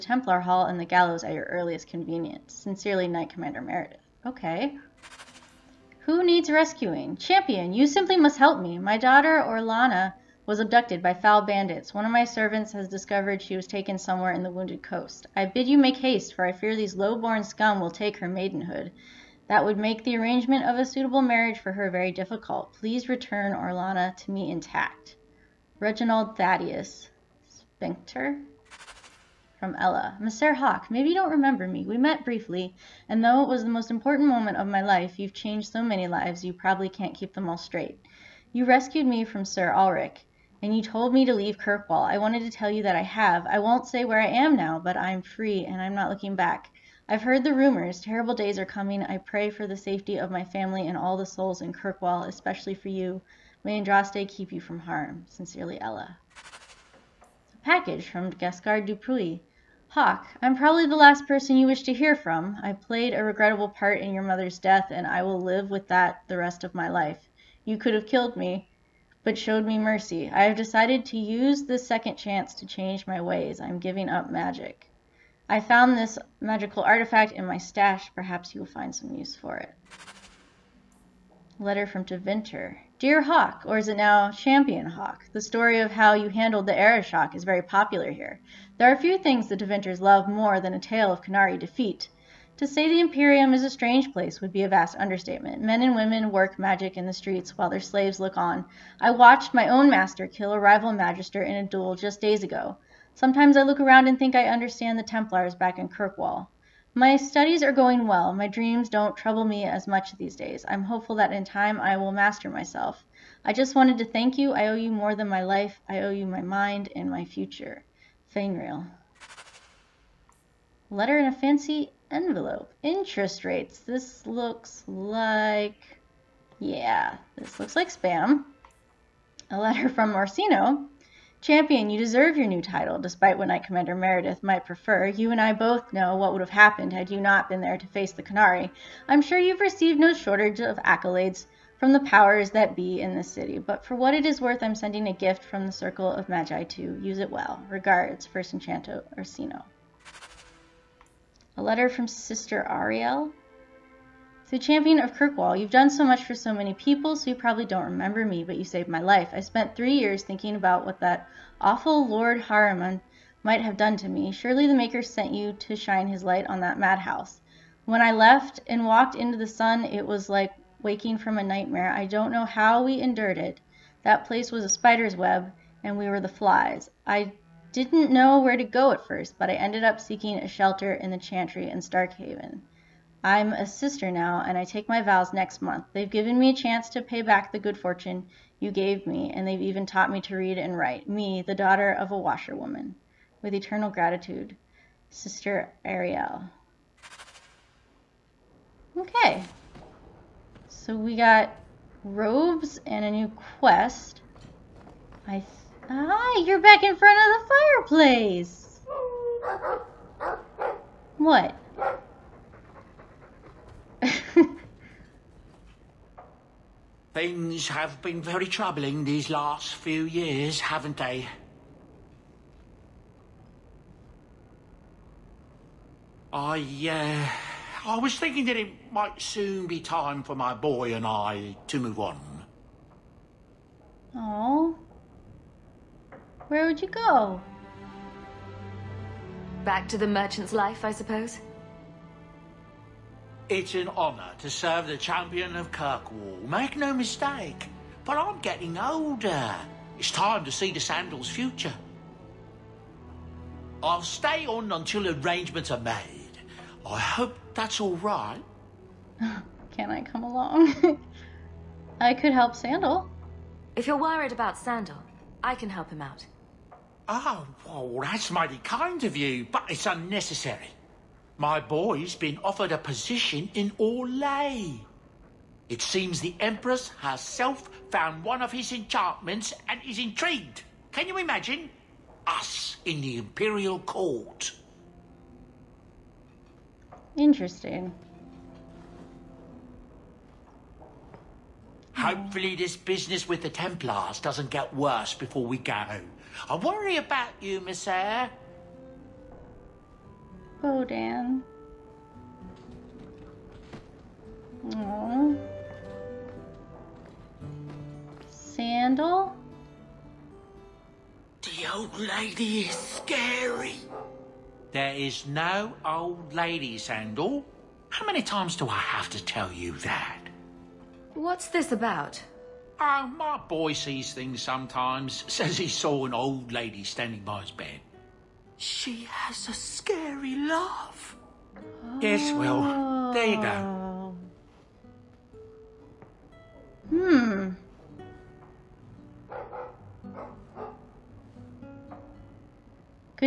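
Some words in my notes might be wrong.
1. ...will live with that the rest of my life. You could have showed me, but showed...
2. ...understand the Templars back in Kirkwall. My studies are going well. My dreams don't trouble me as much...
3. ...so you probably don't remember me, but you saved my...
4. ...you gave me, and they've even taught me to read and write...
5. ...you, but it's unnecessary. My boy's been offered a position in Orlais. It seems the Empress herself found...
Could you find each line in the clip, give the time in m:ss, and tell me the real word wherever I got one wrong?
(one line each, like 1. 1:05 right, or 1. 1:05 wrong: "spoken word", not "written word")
1. 1:05 wrong: "killed", not "showed"
2. 1:44 right
3. 2:37 right
4. 3:08 right
5. 4:29 right.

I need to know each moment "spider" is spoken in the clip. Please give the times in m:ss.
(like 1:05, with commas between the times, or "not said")
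2:54.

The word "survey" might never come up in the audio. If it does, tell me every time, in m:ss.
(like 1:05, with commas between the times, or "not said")
not said.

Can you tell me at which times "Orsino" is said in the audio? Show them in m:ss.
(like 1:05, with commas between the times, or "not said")
2:10, 2:29.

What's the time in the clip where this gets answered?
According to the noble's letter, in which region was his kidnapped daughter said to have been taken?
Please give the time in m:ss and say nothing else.
0:14.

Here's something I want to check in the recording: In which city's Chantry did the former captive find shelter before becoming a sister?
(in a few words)
Starkhaven.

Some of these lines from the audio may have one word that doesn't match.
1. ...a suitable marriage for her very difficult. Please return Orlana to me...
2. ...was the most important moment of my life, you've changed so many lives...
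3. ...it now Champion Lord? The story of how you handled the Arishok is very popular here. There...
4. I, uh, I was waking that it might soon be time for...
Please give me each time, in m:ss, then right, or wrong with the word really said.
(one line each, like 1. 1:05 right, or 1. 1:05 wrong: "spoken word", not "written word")
1. 0:20 right
2. 0:33 right
3. 1:23 wrong: "Hawke", not "Lord"
4. 3:46 wrong: "thinking", not "waking".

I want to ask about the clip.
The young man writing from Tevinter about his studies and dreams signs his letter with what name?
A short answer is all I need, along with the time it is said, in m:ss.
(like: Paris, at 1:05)
Feynriel, at 1:58.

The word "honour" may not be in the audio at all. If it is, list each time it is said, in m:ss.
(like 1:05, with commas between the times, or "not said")
4:03.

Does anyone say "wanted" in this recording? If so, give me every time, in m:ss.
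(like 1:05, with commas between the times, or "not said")
0:42, 1:53.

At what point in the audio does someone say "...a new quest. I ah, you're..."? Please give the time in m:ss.
3:23.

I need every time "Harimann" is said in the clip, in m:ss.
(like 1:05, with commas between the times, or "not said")
2:42.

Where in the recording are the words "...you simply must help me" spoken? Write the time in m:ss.
0:07.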